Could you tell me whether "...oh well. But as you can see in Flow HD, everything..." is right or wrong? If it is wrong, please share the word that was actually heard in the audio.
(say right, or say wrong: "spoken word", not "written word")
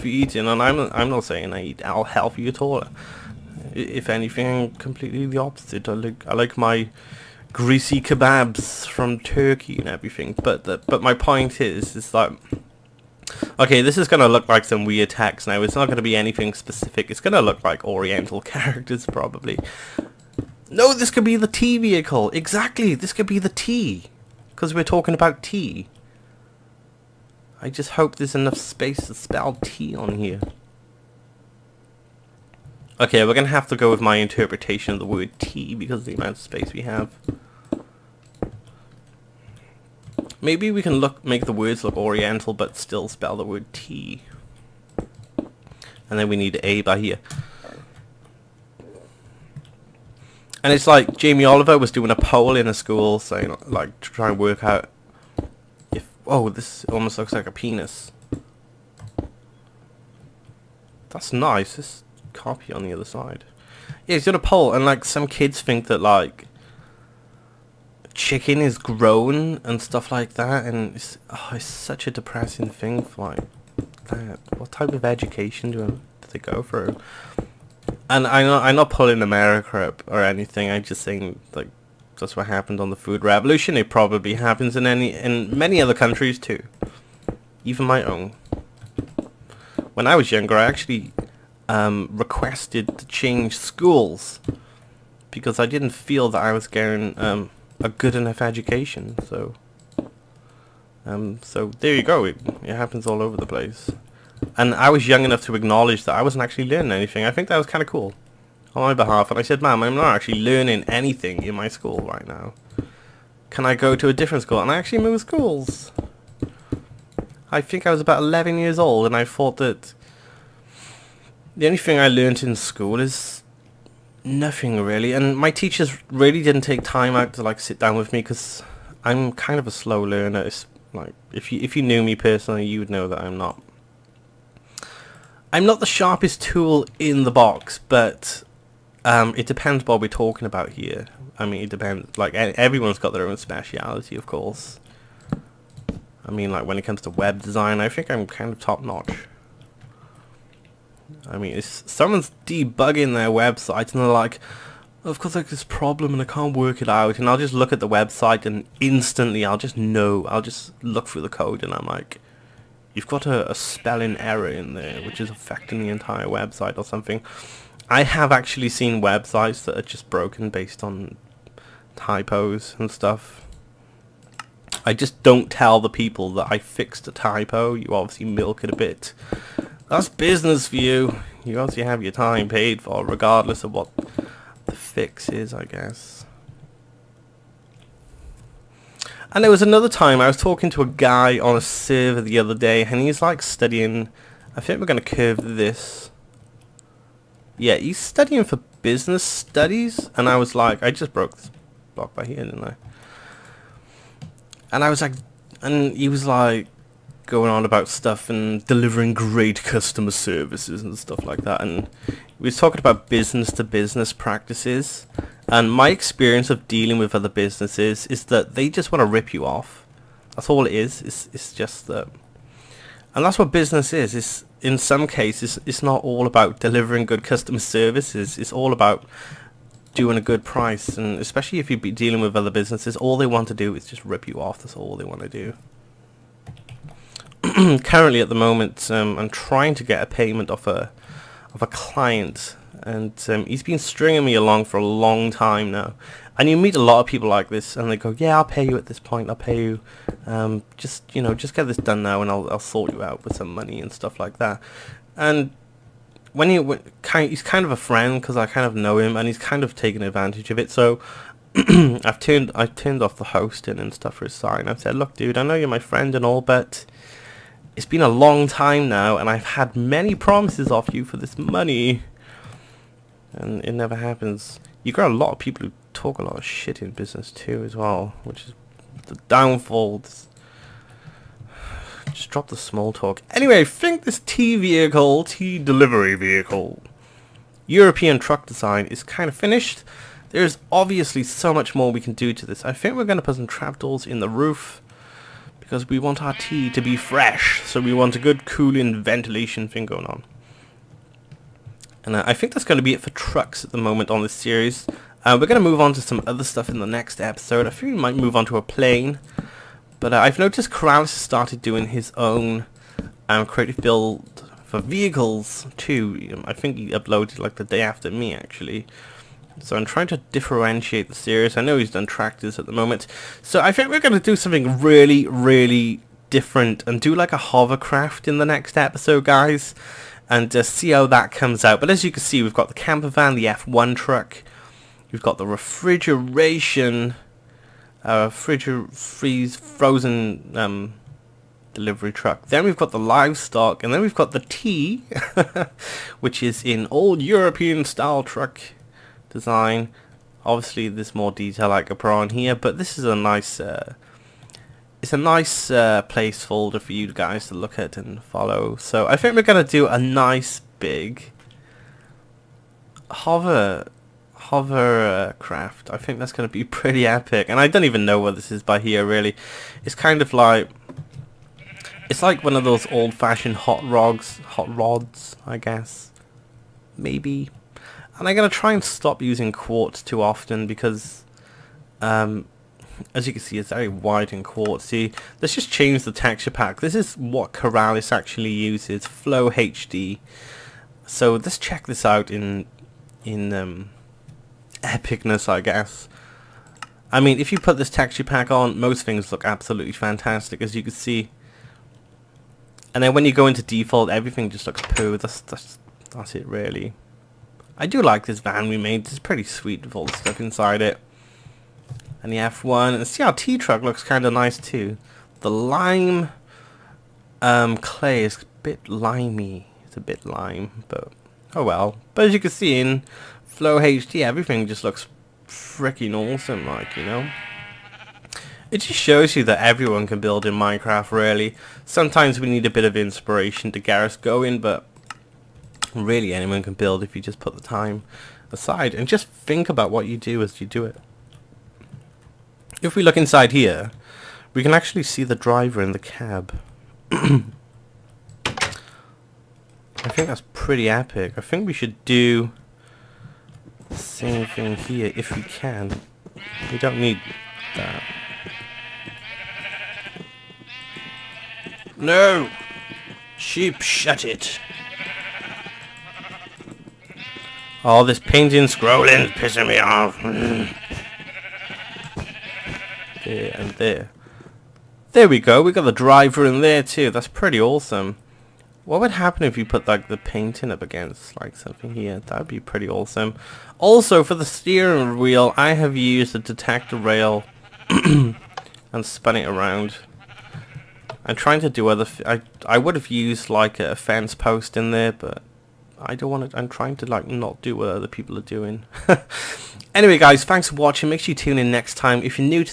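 right.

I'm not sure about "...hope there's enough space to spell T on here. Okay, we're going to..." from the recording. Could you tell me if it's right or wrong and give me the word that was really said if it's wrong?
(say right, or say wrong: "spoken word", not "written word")
right.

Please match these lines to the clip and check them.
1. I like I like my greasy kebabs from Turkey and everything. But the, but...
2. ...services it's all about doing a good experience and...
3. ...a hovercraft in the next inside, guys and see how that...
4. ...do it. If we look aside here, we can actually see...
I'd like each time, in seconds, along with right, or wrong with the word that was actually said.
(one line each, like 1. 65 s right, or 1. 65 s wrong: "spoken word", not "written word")
1. 5 s right
2. 227 s wrong: "price", not "experience"
3. 327 s wrong: "episode", not "inside"
4. 440 s wrong: "inside", not "aside".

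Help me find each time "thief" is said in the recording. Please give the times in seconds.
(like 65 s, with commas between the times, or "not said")
not said.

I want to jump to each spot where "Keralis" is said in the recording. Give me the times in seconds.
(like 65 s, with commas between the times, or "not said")
310 s, 387 s.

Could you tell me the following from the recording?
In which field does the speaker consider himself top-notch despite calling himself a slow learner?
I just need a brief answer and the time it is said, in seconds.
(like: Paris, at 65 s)
web design, at 147 s.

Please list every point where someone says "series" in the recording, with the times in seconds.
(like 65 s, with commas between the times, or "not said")
304 s, 321 s.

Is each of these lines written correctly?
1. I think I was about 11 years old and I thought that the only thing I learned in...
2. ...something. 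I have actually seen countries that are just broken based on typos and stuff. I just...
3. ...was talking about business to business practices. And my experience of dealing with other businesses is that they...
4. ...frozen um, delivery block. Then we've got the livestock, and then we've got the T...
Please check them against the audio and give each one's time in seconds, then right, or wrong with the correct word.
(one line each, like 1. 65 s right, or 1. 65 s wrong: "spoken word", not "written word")
1. 117 s right
2. 166 s wrong: "websites", not "countries"
3. 212 s right
4. 339 s wrong: "truck", not "block".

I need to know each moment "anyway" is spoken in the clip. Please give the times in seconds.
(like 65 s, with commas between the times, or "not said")
283 s, 499 s.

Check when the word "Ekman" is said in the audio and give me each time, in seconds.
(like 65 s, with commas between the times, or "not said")
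not said.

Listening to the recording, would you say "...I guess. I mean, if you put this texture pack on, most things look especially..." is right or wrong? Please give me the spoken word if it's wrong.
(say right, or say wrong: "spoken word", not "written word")
wrong: "absolutely", not "especially".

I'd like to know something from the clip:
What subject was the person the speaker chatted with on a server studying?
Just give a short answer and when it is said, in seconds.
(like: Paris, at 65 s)
business studies, at 198 s.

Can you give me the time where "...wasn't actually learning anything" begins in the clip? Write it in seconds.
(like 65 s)
106 s.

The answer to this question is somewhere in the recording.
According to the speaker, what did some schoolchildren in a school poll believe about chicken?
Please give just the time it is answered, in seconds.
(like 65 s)
68 s.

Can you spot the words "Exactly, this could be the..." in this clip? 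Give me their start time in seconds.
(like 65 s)
22 s.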